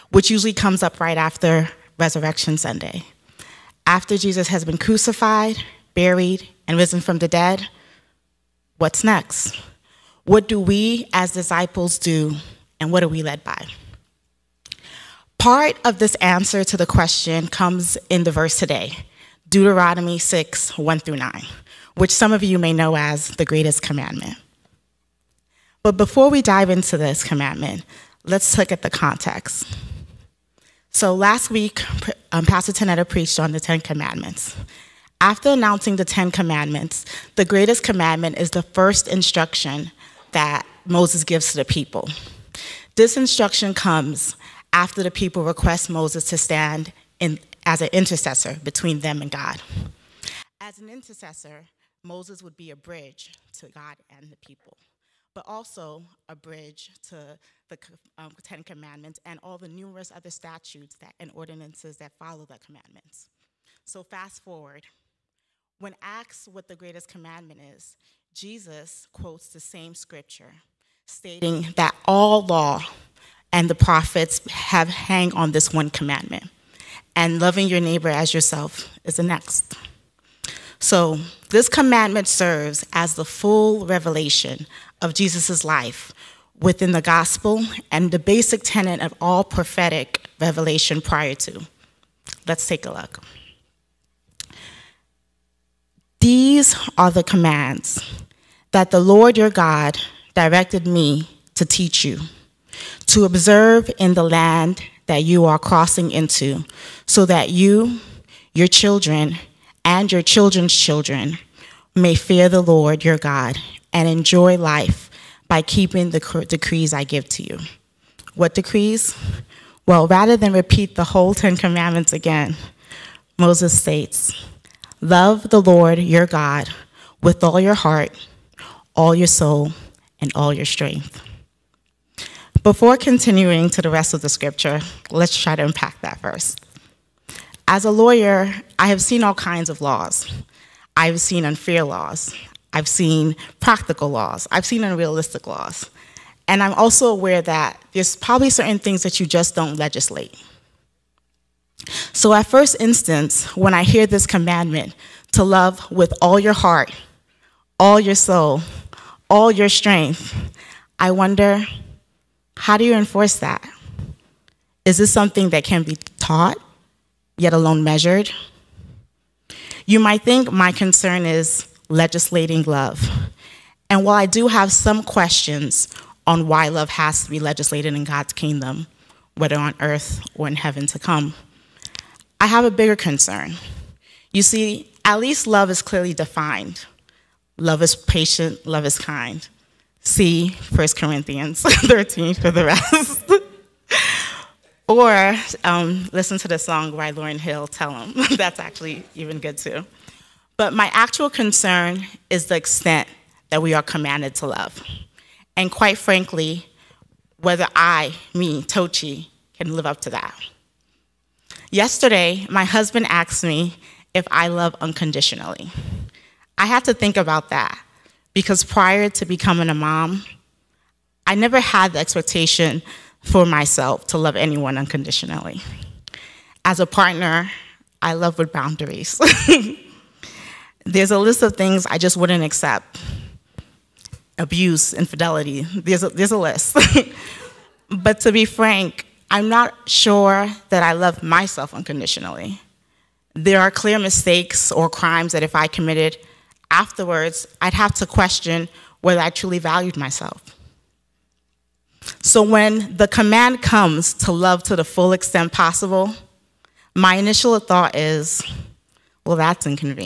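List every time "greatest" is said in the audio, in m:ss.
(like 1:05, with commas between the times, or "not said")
0:23, 0:37, 1:06.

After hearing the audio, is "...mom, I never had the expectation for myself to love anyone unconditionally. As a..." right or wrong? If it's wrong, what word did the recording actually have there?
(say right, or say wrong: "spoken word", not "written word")
right.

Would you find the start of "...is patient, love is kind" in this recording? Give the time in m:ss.
3:07.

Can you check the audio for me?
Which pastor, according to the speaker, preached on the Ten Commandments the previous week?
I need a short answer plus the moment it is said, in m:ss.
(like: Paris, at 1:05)
Pastor Tanetta, at 0:32.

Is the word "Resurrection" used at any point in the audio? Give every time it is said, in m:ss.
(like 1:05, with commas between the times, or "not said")
0:01.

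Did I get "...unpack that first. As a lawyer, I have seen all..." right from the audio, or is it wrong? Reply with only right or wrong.
right.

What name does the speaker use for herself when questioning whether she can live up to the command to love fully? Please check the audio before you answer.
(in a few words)
Toochi.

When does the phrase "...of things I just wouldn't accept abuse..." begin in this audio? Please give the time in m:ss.
3:51.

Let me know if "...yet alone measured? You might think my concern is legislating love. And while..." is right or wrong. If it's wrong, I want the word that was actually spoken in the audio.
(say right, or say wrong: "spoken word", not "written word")
right.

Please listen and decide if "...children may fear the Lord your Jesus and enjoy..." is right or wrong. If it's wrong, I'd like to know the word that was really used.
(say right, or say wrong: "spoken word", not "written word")
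wrong: "God", not "Jesus".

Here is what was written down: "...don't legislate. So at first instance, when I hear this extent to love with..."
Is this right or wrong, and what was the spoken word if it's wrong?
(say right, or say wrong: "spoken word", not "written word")
wrong: "commandment", not "extent".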